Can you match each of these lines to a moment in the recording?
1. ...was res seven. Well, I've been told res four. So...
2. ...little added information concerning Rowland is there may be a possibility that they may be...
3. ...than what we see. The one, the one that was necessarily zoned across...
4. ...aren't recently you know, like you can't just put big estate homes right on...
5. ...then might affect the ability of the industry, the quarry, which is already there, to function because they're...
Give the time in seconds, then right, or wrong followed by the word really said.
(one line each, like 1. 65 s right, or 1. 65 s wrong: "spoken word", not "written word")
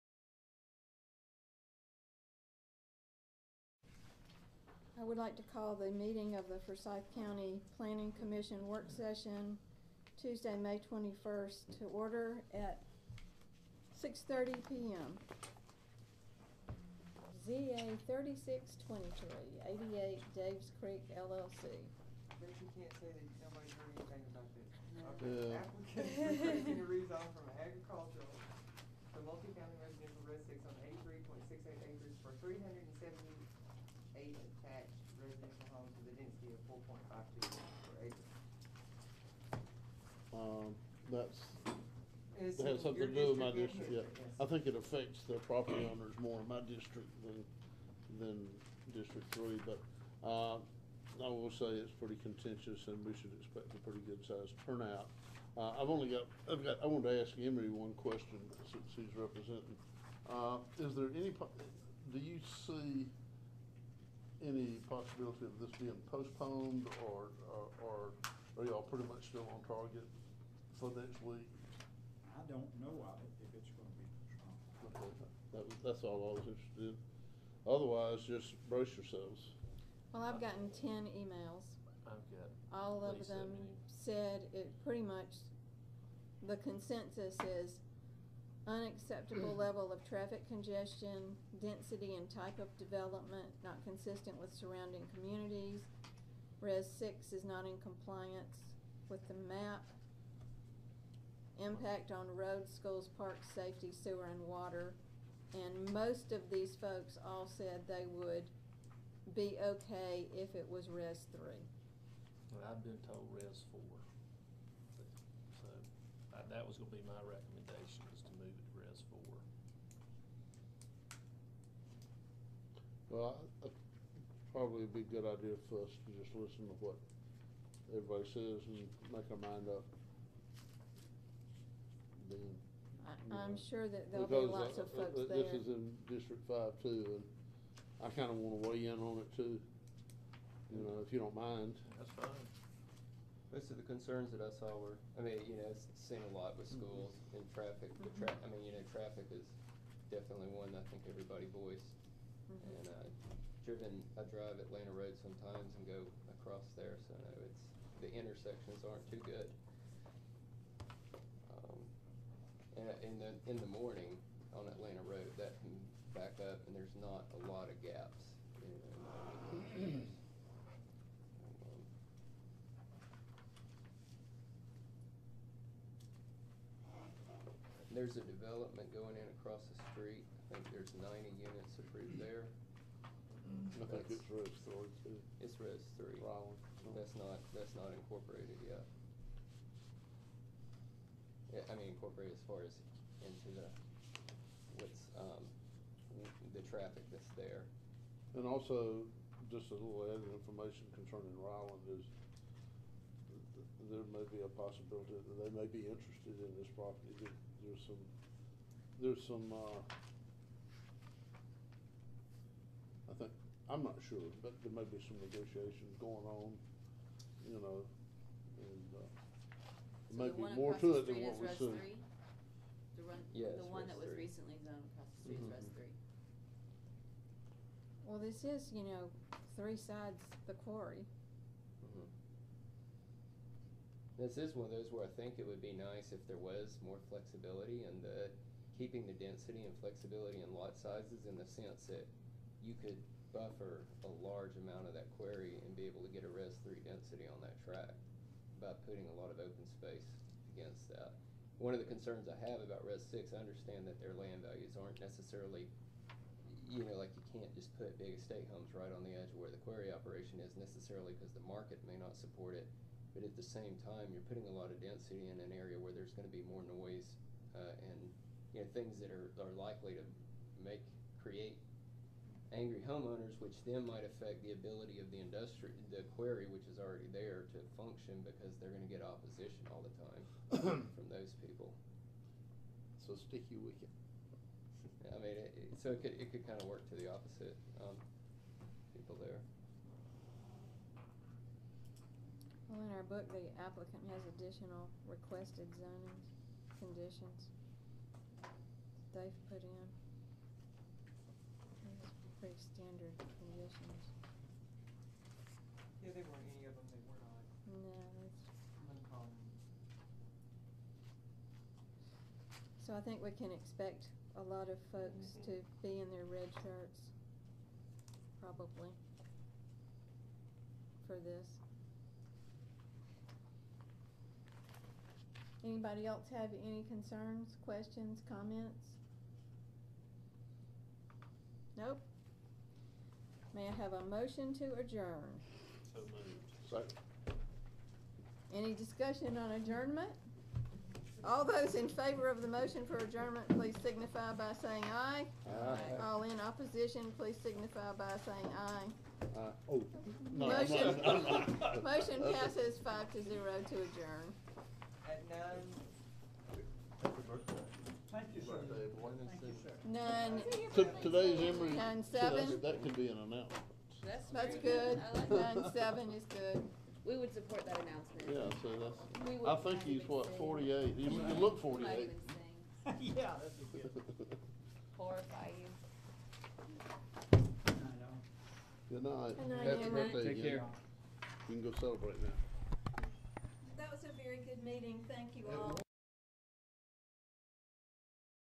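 1. 110 s wrong: "three", not "seven"
2. 199 s right
3. 221 s wrong: "recently", not "necessarily"
4. 254 s wrong: "necessarily", not "recently"
5. 273 s right.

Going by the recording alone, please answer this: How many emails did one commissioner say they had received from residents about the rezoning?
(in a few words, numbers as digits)
10.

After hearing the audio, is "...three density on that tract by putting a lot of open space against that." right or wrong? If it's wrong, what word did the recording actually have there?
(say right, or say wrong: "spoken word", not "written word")
right.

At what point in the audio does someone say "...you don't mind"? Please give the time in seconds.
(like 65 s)
141 s.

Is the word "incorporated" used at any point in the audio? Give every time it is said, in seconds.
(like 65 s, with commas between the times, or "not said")
187 s, 191 s.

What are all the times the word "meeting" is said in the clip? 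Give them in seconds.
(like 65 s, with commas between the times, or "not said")
5 s, 384 s.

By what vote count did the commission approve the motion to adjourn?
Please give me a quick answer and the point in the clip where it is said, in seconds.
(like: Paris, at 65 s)
5 to 0, at 352 s.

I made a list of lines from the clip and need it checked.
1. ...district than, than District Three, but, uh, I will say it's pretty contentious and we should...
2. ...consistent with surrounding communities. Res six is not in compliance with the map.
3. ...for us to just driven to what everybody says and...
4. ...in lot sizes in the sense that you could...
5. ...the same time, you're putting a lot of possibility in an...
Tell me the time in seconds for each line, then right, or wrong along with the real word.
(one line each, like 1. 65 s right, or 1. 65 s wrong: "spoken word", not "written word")
1. 46 s right
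2. 93 s right
3. 125 s wrong: "listen", not "driven"
4. 240 s right
5. 263 s wrong: "density", not "possibility".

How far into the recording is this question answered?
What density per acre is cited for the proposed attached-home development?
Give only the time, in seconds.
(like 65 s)
36 s.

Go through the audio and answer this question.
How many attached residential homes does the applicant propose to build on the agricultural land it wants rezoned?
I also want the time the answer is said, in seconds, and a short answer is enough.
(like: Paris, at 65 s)
378, at 32 s.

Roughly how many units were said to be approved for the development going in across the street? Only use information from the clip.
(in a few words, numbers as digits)
90.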